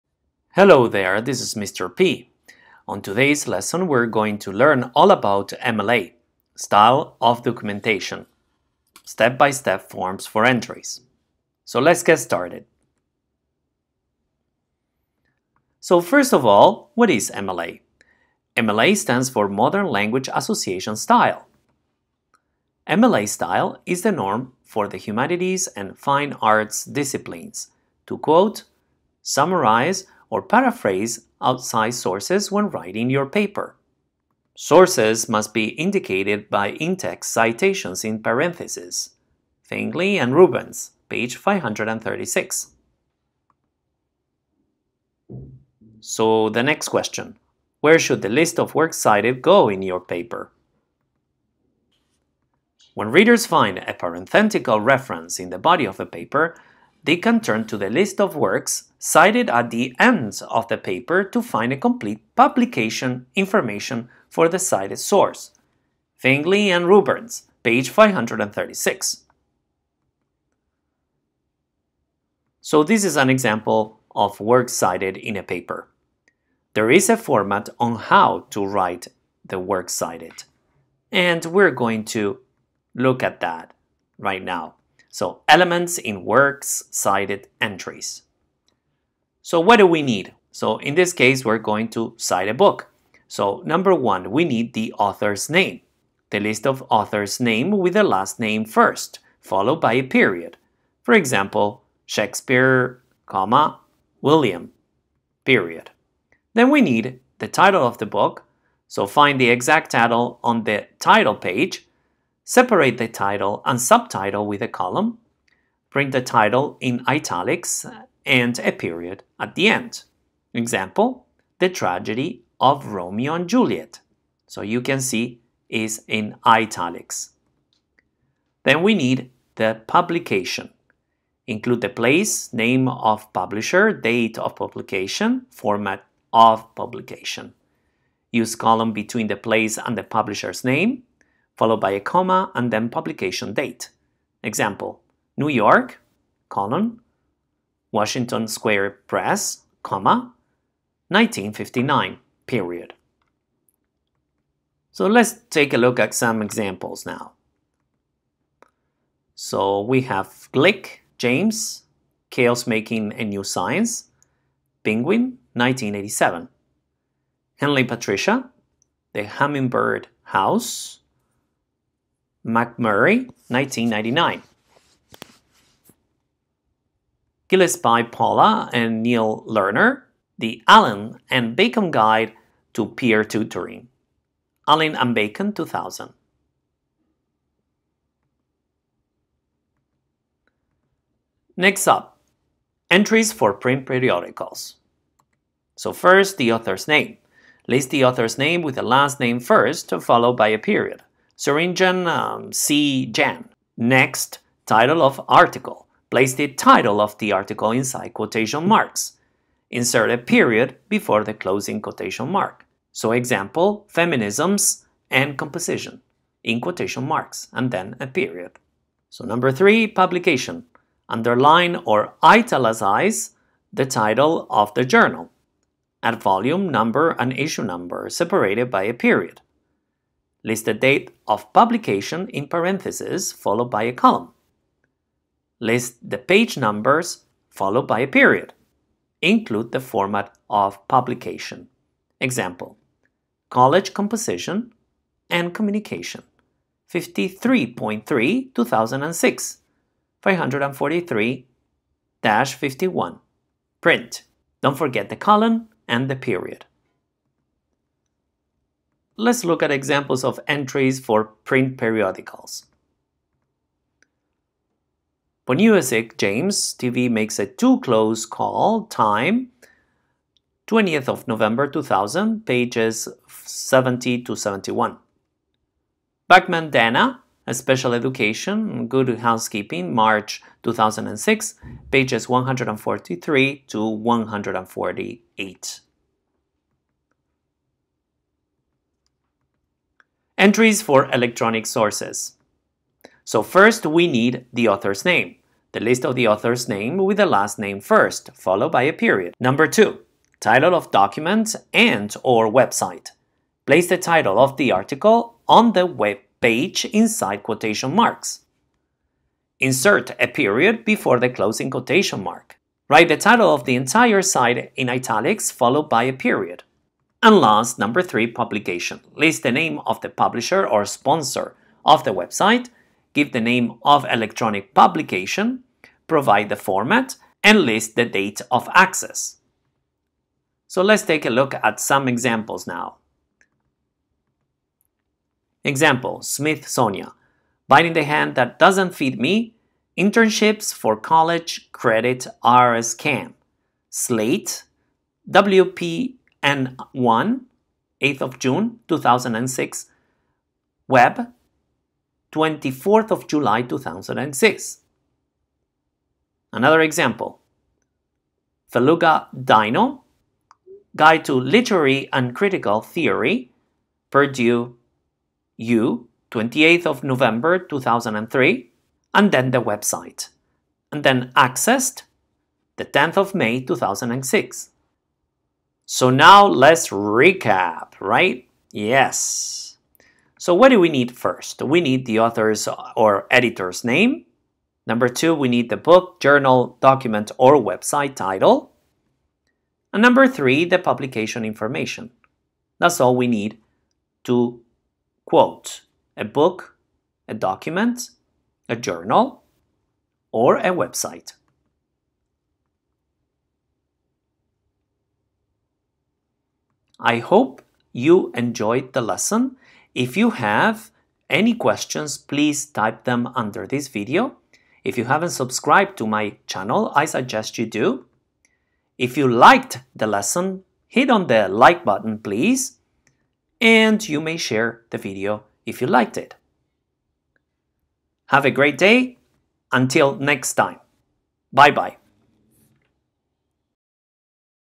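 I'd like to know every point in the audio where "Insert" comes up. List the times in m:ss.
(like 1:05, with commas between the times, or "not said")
3:29, 5:09.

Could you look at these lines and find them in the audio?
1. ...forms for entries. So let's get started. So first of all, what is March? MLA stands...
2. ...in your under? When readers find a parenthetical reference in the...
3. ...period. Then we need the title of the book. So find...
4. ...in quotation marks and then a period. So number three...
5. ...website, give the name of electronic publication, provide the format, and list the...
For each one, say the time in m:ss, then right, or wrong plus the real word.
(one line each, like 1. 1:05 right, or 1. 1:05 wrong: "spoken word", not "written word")
1. 0:09 wrong: "MLA", not "March"
2. 0:49 wrong: "paper", not "under"
3. 1:45 right
4. 3:36 right
5. 5:22 right.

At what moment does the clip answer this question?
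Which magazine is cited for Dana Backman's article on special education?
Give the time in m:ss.
4:38.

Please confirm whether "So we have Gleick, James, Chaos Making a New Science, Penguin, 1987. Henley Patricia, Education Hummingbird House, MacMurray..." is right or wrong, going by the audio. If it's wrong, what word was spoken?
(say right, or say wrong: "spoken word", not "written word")
wrong: "The", not "Education".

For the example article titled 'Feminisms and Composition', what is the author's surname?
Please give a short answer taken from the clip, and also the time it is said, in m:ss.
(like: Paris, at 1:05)
Swearingen, at 3:21.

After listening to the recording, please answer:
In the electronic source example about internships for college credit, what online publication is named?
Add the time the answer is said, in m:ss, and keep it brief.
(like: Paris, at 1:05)
Slate, at 5:43.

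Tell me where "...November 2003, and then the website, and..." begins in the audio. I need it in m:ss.
6:07.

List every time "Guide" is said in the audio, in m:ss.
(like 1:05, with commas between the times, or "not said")
3:01, 6:00.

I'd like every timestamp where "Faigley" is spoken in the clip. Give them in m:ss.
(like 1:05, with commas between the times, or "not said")
0:39, 1:06.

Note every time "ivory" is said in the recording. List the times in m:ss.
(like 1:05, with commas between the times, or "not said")
not said.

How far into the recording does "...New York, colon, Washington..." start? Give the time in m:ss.
2:25.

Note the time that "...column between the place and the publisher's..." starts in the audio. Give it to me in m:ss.
2:18.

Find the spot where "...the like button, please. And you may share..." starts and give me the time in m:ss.
7:01.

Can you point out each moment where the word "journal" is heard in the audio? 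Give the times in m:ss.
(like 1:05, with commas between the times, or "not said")
3:44, 6:26, 6:38.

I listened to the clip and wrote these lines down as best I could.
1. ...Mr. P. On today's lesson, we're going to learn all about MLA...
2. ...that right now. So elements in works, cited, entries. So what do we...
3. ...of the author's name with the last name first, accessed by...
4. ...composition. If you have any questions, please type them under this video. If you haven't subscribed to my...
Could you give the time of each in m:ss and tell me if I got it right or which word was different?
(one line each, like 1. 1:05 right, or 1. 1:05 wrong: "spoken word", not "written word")
1. 0:01 right
2. 1:23 right
3. 4:56 wrong: "followed", not "accessed"
4. 6:49 wrong: "lesson", not "composition".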